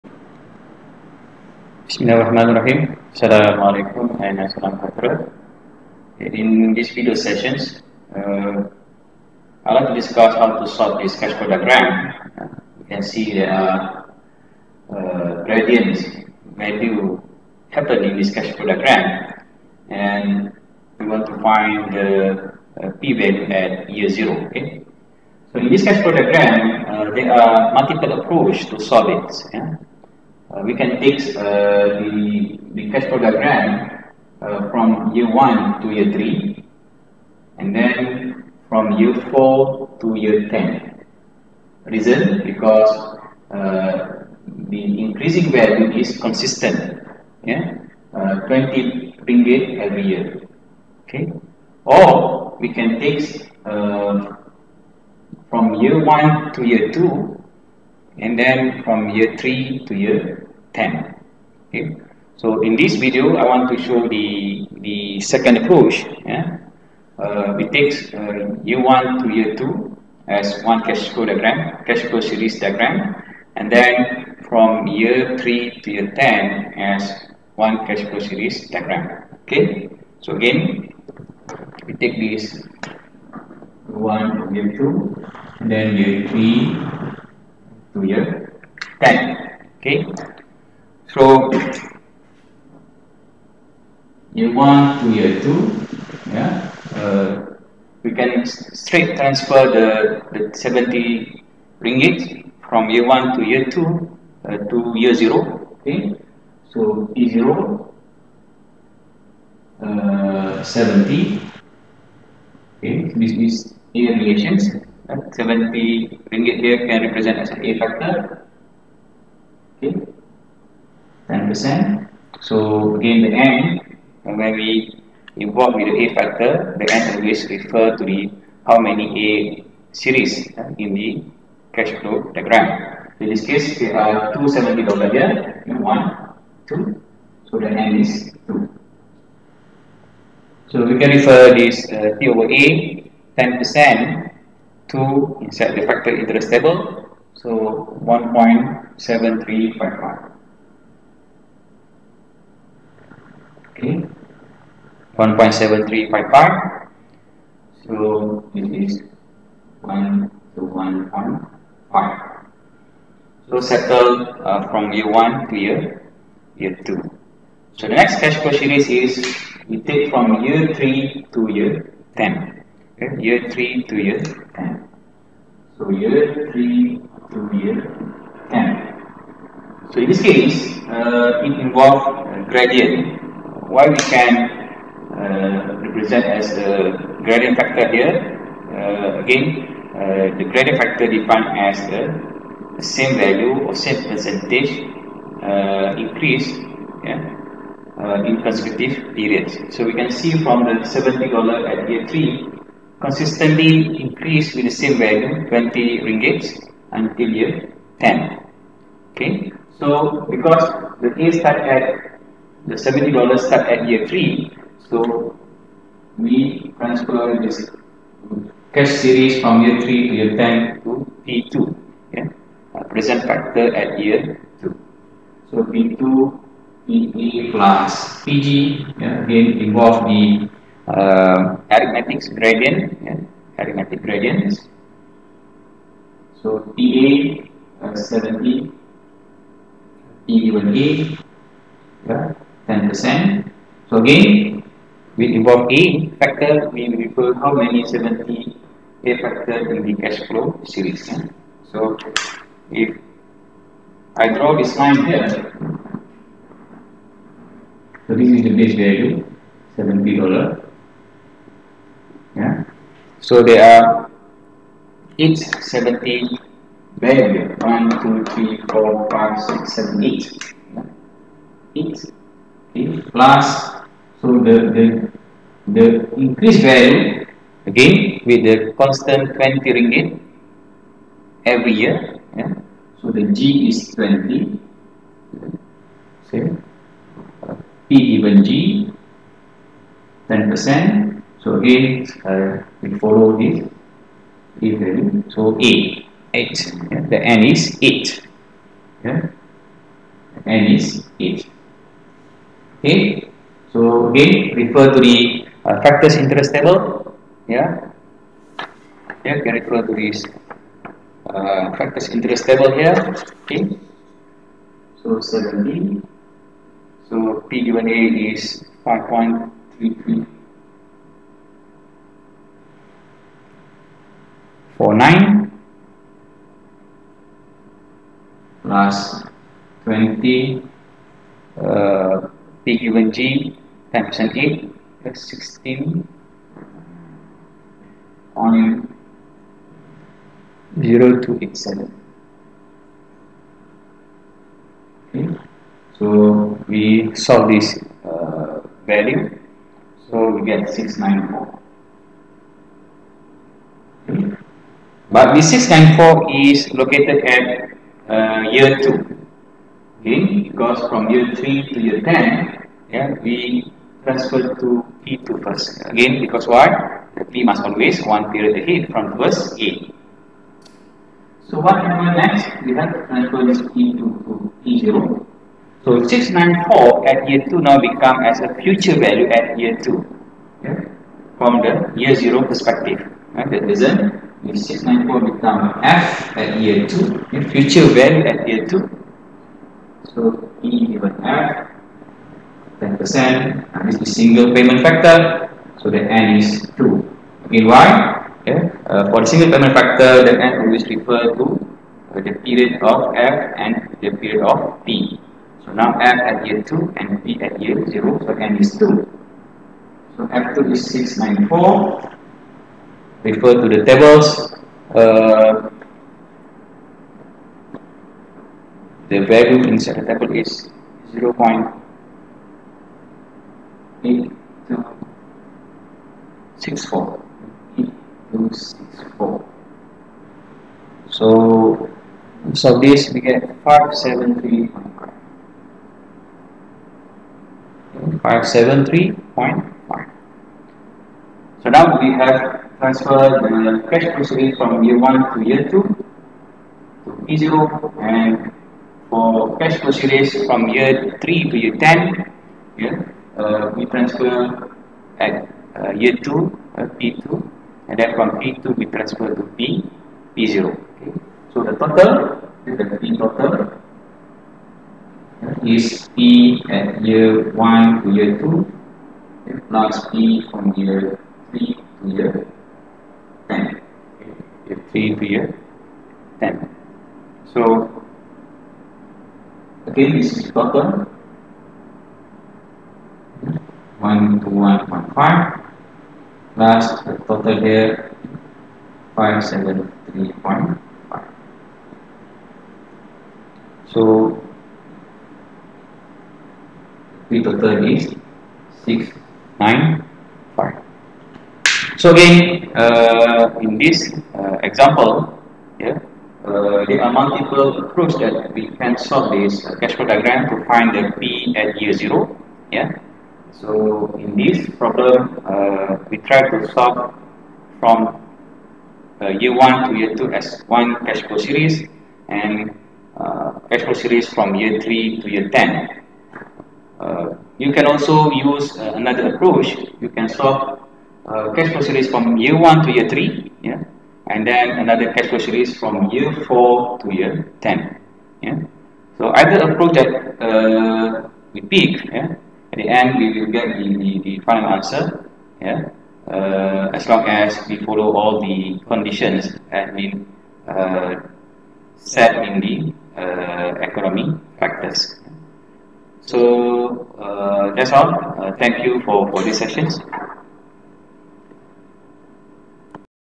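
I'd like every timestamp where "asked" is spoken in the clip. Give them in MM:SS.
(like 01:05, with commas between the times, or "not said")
not said.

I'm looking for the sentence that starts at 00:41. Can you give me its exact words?
Reason because the increasing value is consistent.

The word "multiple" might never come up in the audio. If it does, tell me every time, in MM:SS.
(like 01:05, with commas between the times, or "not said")
00:27, 08:27.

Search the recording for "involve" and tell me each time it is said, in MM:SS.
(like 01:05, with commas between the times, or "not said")
02:05, 03:01, 03:49, 04:05.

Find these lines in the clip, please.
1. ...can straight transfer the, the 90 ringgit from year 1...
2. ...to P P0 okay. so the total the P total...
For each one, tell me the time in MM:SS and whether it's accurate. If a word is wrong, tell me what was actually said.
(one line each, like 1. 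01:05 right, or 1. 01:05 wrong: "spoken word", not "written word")
1. 01:38 wrong: "70", not "90"
2. 07:39 right.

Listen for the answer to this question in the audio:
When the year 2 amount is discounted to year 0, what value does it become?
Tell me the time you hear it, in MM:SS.
08:09.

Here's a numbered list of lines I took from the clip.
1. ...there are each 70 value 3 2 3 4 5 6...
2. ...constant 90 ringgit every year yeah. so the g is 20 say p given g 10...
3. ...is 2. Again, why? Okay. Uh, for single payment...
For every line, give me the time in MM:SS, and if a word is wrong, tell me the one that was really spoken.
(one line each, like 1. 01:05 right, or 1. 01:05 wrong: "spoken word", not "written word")
1. 04:23 wrong: "1", not "3"
2. 04:38 wrong: "20", not "90"
3. 06:36 right.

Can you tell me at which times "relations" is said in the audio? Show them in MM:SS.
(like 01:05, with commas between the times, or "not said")
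01:54.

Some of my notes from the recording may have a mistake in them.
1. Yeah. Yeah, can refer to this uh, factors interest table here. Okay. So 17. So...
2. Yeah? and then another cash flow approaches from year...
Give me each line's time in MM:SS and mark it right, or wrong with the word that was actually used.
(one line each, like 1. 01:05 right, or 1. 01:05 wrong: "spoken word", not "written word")
1. 05:07 right
2. 08:53 wrong: "series", not "approaches".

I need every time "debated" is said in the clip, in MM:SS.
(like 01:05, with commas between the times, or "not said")
not said.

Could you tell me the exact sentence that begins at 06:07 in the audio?
The P must always one period ahead from verse A.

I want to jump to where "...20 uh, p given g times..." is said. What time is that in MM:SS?
05:29.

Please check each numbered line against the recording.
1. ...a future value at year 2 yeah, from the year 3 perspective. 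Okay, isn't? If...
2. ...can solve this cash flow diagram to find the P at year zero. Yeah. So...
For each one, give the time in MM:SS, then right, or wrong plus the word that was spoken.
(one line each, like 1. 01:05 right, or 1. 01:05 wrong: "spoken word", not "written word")
1. 06:18 wrong: "0", not "3"
2. 08:28 right.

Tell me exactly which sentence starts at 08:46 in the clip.
Uh, you can also use uh, another approach.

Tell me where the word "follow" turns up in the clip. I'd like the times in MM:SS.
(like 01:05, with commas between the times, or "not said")
04:52, 09:07.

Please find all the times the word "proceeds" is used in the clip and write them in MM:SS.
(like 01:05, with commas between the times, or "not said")
07:24, 07:29.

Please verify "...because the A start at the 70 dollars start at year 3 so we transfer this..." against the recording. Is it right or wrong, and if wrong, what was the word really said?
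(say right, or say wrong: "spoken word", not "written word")
right.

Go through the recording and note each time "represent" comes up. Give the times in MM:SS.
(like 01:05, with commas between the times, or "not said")
01:57, 03:05.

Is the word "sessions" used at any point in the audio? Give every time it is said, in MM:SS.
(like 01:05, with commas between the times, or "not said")
00:07, 09:19.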